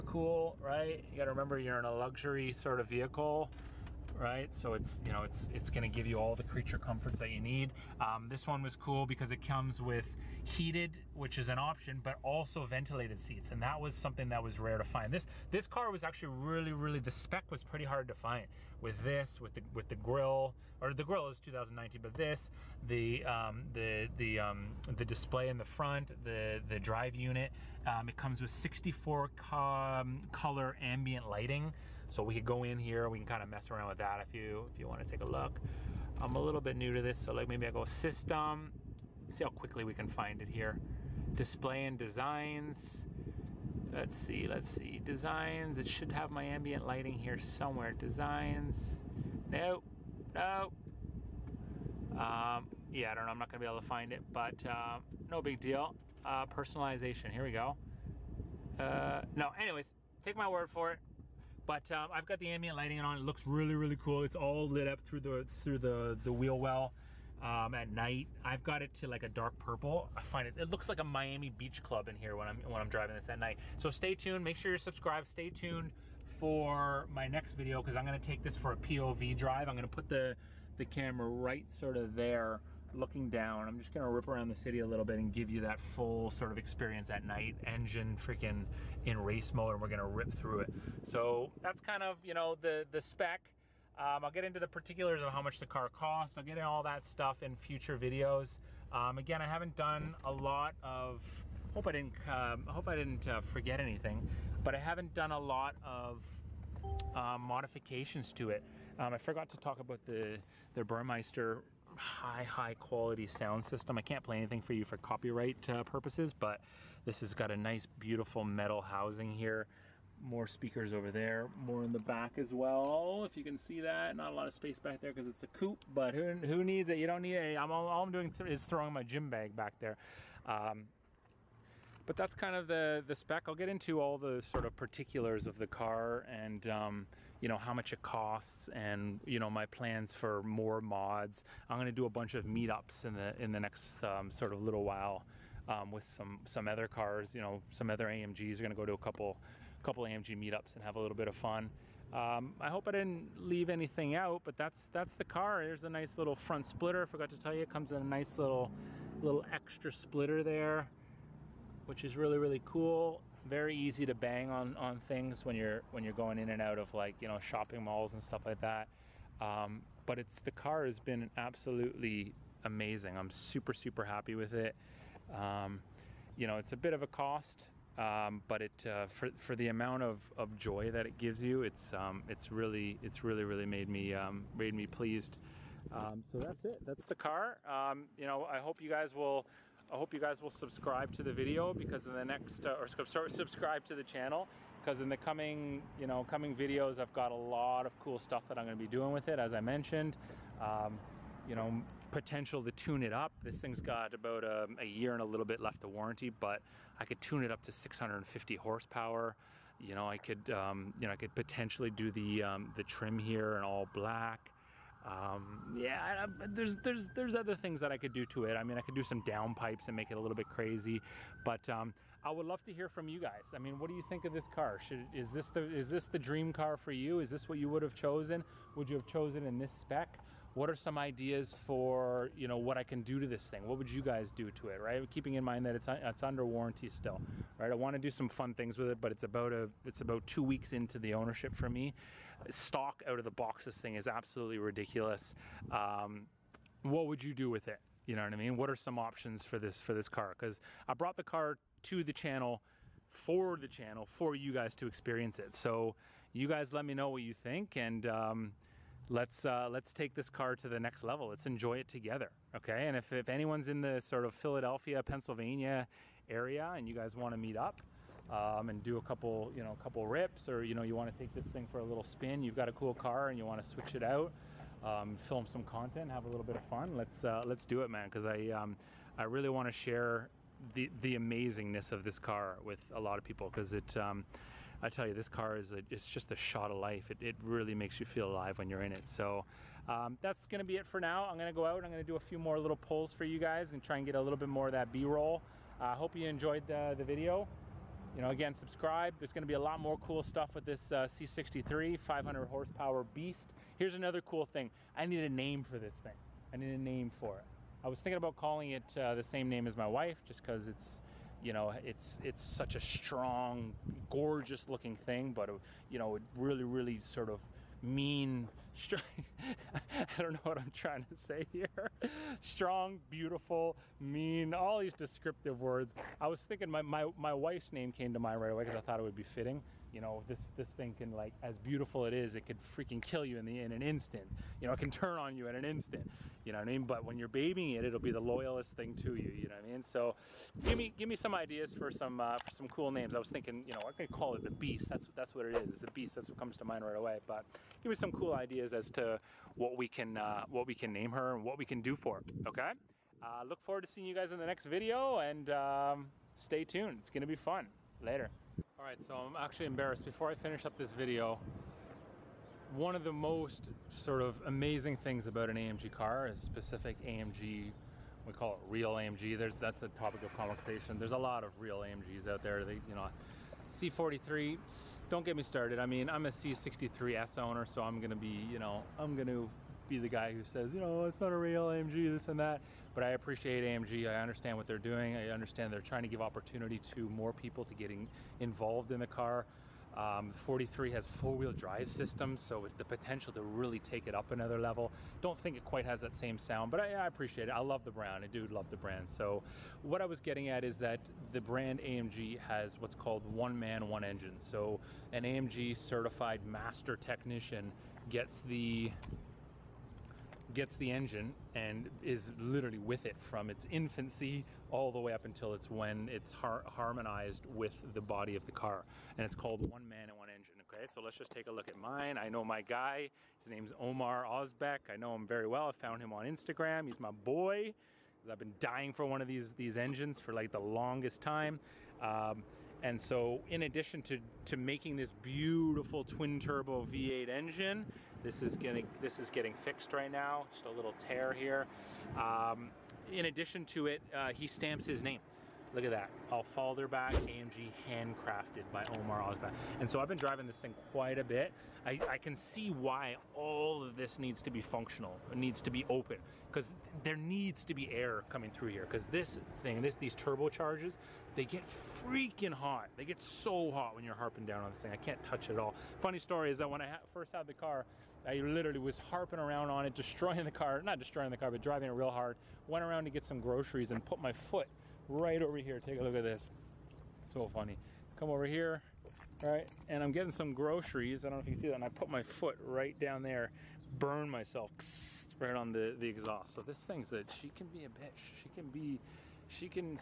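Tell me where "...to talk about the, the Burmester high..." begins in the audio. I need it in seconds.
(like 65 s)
109 s.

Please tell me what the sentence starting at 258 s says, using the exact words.
Um, let's uh, let's take this car to the next level.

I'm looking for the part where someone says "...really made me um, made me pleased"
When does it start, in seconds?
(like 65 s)
183 s.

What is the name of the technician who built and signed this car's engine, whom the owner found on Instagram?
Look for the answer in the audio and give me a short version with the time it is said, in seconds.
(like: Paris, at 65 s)
Omar Osbeck, at 423 s.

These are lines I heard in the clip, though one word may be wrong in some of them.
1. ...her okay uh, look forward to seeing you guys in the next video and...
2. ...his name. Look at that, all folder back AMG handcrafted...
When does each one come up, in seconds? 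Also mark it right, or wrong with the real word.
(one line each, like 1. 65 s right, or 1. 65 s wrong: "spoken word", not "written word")
1. 352 s right
2. 444 s right.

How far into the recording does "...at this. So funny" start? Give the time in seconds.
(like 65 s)
476 s.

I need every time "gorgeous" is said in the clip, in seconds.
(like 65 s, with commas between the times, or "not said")
314 s.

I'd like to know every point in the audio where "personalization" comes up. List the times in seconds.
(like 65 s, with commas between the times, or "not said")
56 s.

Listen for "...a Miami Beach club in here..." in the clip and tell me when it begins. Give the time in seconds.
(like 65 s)
70 s.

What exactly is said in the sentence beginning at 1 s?
You got to remember you're in a luxury sort of vehicle right?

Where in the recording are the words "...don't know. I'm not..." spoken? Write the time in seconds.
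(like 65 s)
53 s.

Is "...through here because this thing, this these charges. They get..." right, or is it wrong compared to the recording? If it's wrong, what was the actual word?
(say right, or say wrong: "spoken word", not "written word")
right.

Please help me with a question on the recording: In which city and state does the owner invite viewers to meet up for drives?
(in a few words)
Philadelphia, Pennsylvania.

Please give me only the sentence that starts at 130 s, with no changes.
Um, but that's kind of the the spec.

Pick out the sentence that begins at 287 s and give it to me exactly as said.
It, it really makes you feel alive when you're in it.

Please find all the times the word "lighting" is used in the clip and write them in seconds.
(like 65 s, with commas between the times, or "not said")
31 s, 46 s, 62 s.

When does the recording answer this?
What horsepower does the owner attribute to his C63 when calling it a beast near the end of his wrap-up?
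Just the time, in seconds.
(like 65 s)
301 s.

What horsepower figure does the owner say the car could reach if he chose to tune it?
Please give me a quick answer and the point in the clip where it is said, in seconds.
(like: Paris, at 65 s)
650 horsepower, at 207 s.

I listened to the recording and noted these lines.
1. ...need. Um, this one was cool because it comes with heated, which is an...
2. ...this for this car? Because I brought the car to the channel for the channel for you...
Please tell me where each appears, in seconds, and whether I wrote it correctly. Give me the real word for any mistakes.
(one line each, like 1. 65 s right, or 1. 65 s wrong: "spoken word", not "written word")
1. 7 s right
2. 249 s right.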